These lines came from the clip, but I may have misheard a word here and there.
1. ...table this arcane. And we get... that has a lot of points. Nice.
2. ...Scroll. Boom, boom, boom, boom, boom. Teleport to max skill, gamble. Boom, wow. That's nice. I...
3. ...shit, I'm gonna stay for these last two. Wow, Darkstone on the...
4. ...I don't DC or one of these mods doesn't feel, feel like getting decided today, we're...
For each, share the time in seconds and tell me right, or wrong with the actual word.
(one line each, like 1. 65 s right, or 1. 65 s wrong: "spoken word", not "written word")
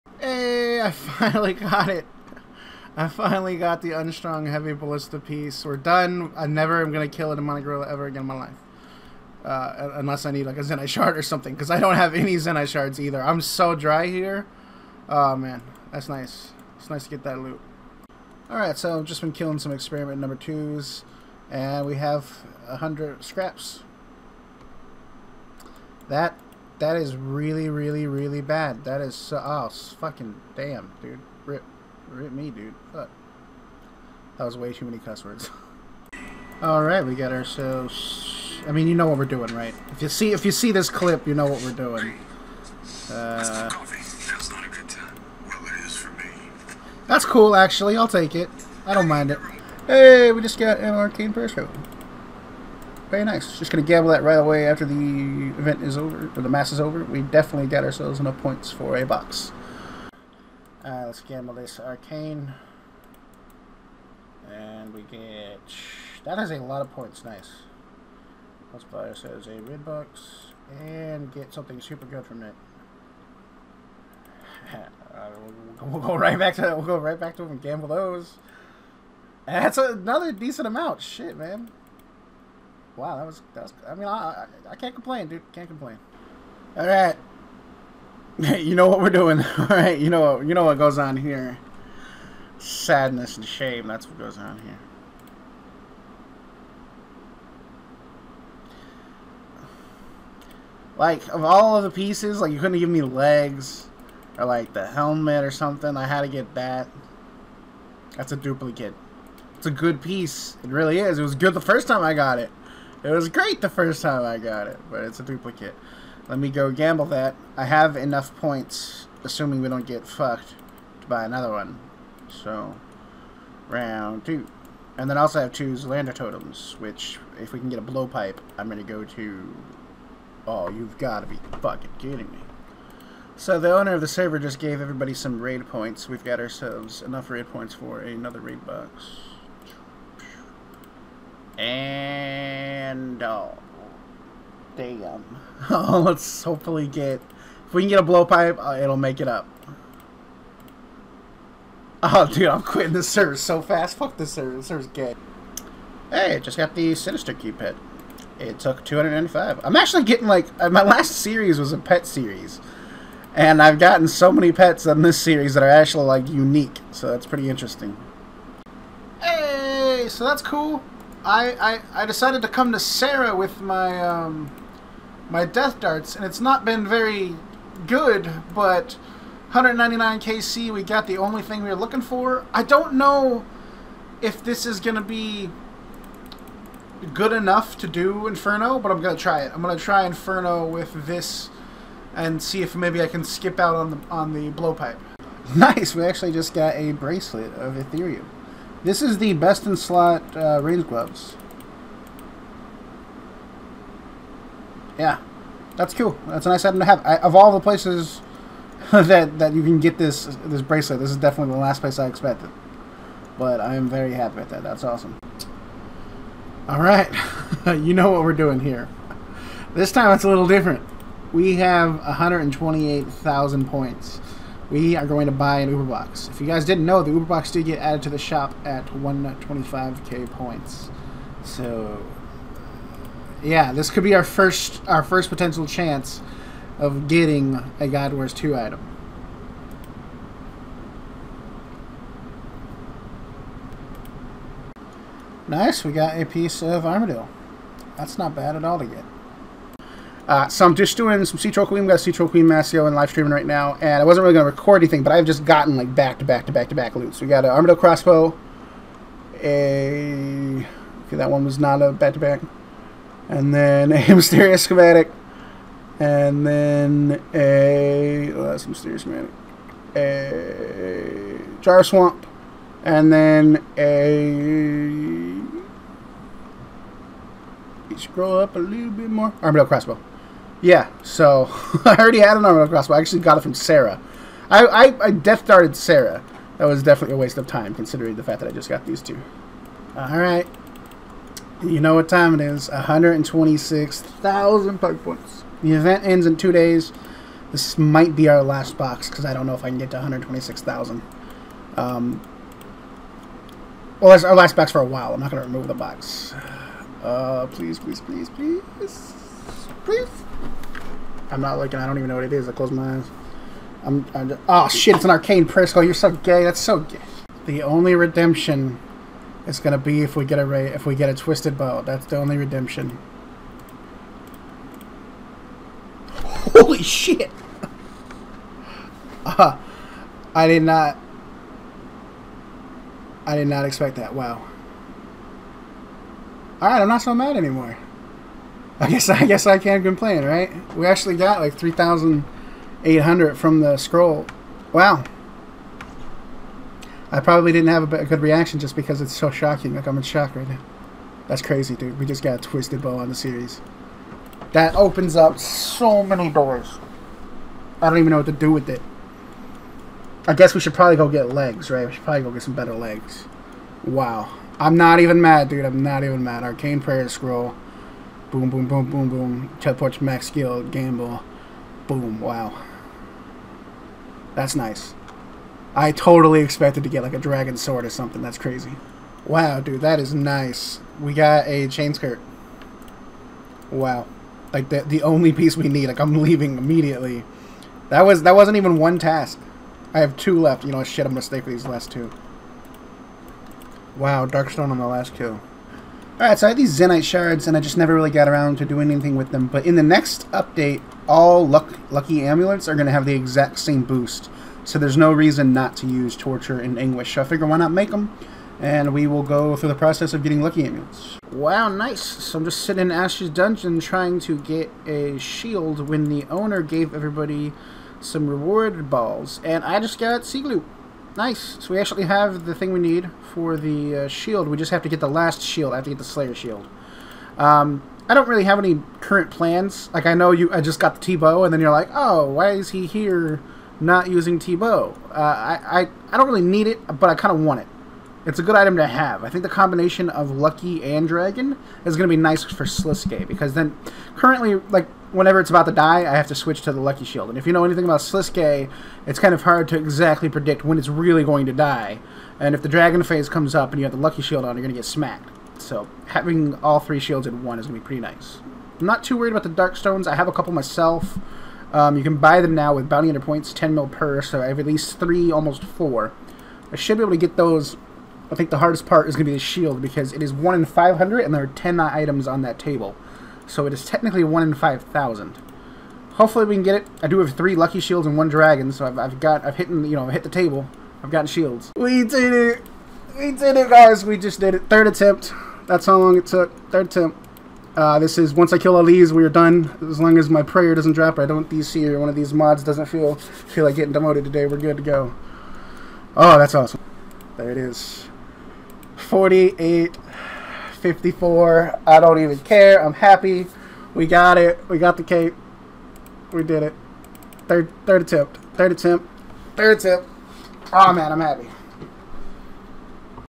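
1. 61 s wrong: "gamble", not "table"
2. 367 s right
3. 390 s right
4. 491 s wrong: "demoted", not "decided".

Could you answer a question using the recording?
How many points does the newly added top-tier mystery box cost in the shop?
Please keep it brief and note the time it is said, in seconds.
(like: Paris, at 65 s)
125k, at 228 s.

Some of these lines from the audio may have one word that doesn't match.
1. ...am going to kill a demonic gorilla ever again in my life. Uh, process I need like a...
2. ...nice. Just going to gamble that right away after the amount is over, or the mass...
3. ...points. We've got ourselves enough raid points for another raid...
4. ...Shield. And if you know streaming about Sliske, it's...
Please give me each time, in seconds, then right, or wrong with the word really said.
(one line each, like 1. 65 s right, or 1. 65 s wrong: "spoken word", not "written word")
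1. 6 s wrong: "unless", not "process"
2. 53 s wrong: "event", not "amount"
3. 135 s right
4. 447 s wrong: "anything", not "streaming".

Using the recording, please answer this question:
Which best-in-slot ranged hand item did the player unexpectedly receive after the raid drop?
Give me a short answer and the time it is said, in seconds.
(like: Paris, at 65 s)
Bracelet of Ethereum, at 196 s.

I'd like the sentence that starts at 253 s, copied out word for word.
And I wasn't really going to record anything, but I've just gotten like back to back to back to back loots.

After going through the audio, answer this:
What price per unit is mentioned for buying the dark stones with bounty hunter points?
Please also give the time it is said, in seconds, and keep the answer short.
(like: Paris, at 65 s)
10 mil, at 463 s.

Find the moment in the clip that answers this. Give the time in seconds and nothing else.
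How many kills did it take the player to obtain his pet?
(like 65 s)
158 s.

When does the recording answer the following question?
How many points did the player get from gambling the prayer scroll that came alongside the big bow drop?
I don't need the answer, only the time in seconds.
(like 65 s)
341 s.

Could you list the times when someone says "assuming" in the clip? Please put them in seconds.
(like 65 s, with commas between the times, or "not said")
119 s.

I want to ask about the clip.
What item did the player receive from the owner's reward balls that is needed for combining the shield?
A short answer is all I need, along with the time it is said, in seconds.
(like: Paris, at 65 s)
Sea Glue, at 420 s.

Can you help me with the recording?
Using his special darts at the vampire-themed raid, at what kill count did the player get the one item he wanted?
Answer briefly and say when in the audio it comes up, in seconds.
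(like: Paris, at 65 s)
199, at 179 s.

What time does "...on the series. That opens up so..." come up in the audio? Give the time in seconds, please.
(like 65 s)
352 s.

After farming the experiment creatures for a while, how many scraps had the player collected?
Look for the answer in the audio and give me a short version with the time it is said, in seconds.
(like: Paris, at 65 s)
100, at 22 s.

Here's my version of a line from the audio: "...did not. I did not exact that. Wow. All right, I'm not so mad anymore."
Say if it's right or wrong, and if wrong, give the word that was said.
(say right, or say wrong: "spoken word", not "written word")
wrong: "expect", not "exact".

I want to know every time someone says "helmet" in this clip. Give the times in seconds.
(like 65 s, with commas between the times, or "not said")
104 s.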